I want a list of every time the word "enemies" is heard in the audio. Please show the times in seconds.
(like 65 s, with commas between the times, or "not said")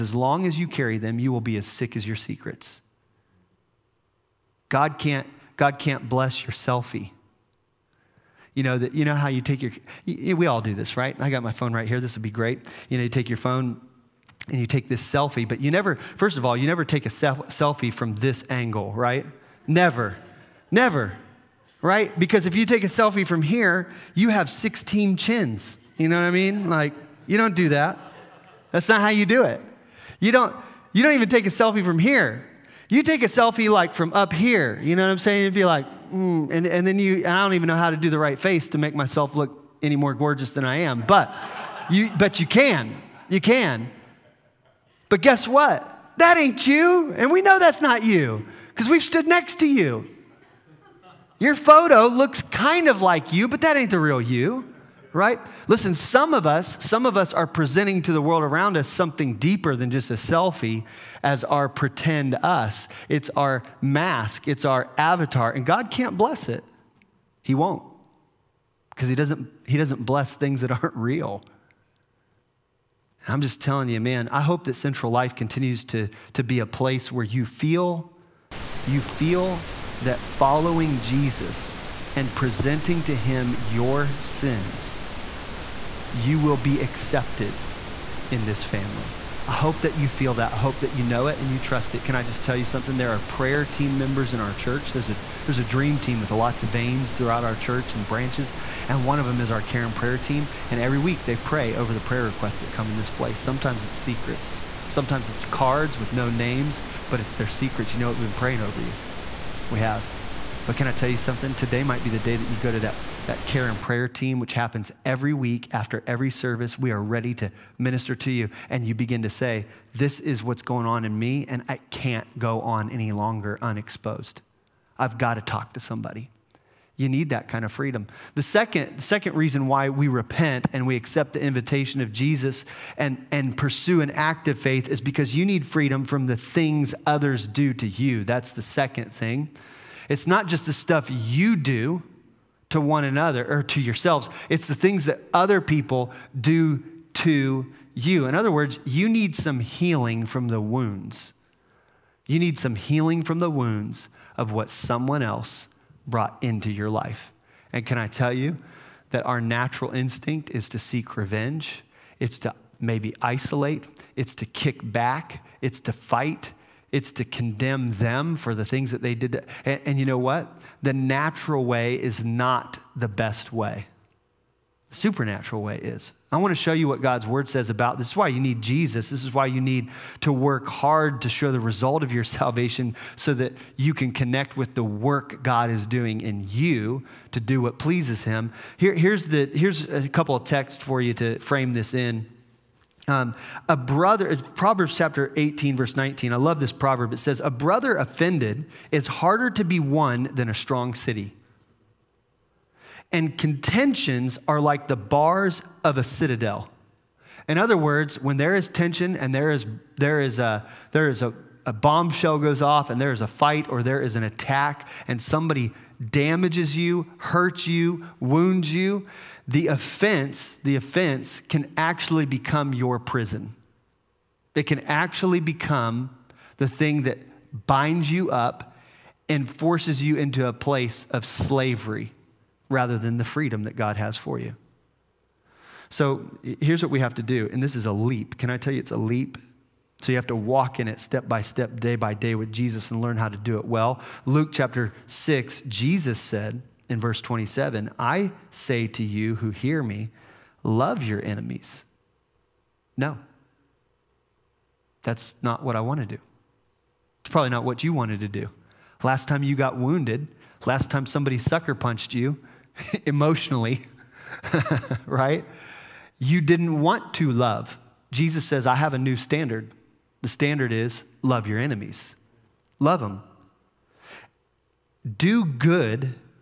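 251 s, 271 s.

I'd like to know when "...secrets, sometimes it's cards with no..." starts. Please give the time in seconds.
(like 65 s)
103 s.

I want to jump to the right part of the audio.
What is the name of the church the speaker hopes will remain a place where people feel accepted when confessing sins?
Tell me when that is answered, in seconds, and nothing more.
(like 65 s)
74 s.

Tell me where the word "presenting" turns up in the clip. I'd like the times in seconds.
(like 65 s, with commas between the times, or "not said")
57 s, 82 s.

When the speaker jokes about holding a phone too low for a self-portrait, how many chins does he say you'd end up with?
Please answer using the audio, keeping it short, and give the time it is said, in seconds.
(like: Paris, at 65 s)
16, at 24 s.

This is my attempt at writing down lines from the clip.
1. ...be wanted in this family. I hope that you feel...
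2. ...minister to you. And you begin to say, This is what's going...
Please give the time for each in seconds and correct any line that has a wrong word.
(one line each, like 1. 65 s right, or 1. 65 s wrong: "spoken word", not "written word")
1. 86 s wrong: "accepted", not "wanted"
2. 117 s right.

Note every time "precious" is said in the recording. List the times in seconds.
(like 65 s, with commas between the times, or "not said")
not said.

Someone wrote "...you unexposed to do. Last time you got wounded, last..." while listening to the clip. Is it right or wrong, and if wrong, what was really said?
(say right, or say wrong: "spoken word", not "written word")
wrong: "wanted", not "unexposed".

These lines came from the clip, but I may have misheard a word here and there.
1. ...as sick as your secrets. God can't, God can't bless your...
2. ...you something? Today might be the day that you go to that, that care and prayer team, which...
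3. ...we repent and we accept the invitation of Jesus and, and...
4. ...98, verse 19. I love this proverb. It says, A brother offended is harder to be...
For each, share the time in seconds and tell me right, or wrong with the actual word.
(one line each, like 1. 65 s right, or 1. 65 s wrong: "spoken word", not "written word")
1. 1 s right
2. 111 s right
3. 129 s right
4. 195 s wrong: "18", not "98".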